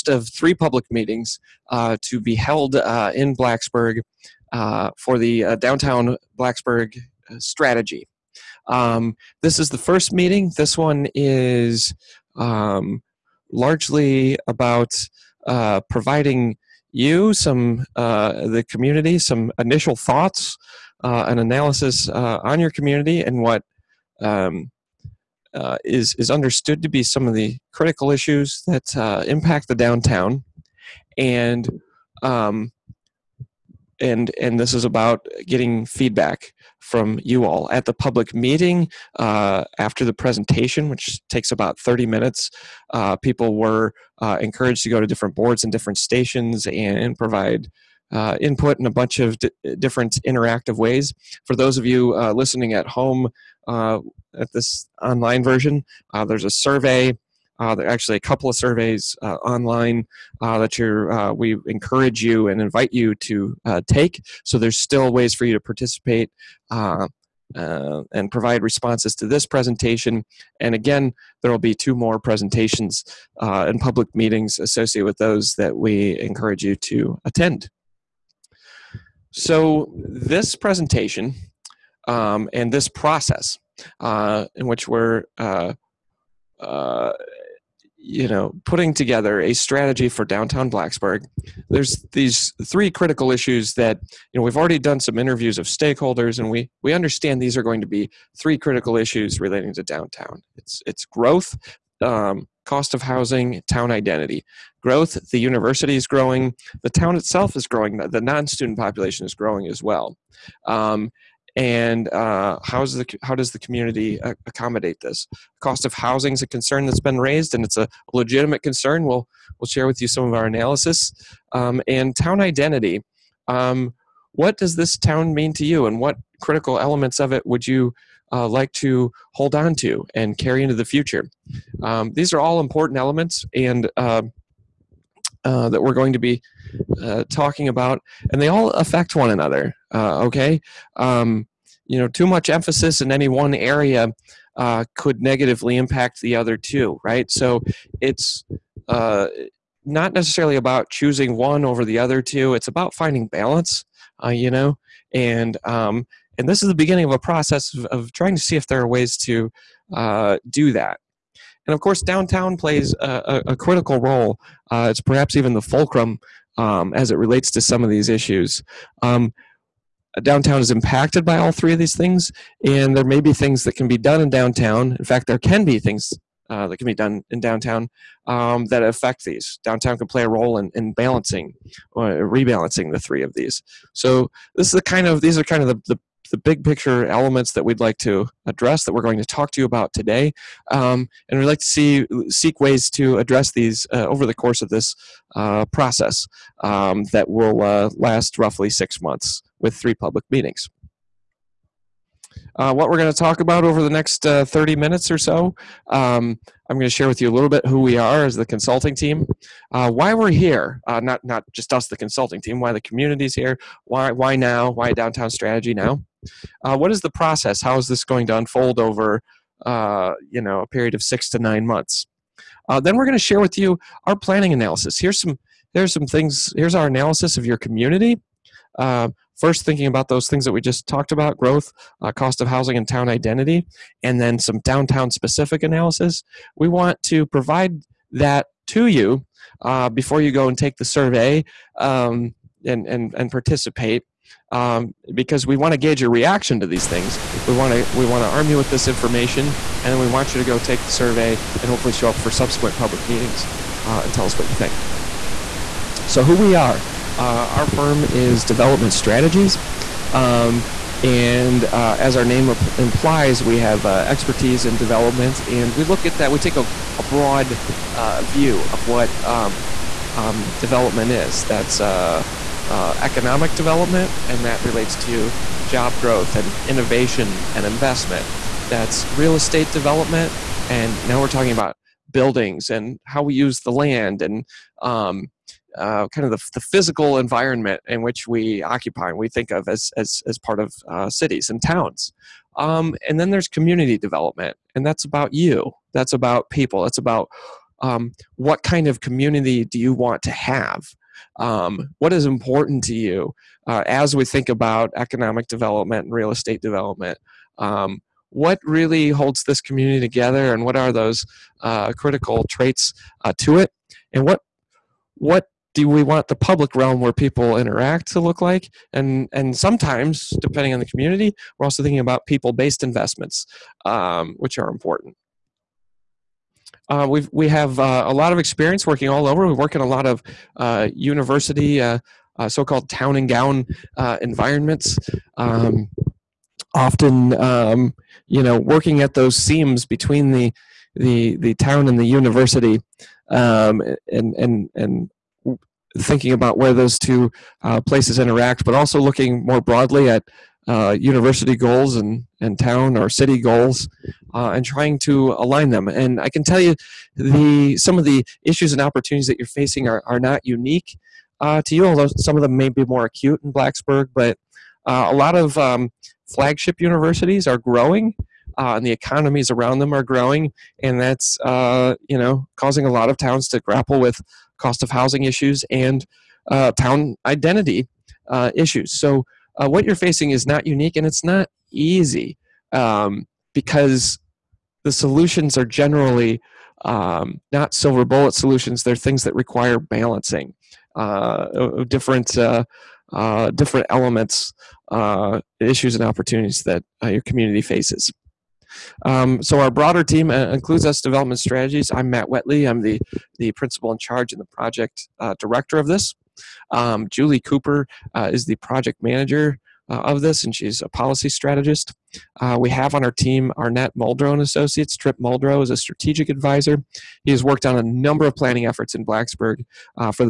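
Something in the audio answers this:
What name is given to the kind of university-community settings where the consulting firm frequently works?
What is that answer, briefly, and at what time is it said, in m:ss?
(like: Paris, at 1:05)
Town and gown, at 5:32.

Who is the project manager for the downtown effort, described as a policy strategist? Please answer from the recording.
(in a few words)
Julie Cooper.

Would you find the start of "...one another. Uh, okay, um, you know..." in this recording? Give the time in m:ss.
2:19.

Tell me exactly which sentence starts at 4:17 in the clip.
Uh, our firm is Development Strategies.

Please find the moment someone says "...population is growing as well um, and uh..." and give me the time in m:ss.
1:48.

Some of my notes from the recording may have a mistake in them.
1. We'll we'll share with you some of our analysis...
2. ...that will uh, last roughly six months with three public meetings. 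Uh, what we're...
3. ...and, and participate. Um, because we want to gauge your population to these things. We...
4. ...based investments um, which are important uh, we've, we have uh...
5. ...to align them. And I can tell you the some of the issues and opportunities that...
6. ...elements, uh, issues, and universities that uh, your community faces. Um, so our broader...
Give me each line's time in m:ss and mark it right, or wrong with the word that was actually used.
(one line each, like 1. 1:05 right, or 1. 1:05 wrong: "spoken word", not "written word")
1. 1:59 right
2. 3:17 right
3. 4:02 wrong: "reaction", not "population"
4. 5:22 right
5. 5:54 right
6. 6:33 wrong: "opportunities", not "universities".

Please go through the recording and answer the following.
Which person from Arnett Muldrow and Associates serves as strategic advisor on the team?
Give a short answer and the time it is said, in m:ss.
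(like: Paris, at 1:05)
Tripp Muldrow, at 6:54.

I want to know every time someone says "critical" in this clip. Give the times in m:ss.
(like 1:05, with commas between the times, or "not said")
0:27, 1:32, 1:38, 2:06, 2:43, 5:11.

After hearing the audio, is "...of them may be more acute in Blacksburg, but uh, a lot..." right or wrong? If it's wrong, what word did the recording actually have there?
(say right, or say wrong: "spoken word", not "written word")
right.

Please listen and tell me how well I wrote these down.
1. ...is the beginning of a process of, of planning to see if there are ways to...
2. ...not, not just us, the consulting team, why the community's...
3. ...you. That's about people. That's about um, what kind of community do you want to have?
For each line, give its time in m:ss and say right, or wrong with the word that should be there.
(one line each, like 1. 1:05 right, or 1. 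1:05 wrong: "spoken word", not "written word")
1. 2:36 wrong: "trying", not "planning"
2. 3:30 right
3. 4:55 right.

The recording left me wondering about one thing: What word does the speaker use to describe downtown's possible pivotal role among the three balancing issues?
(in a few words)
Fulcrum.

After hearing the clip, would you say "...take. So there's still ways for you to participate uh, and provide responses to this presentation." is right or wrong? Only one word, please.
right.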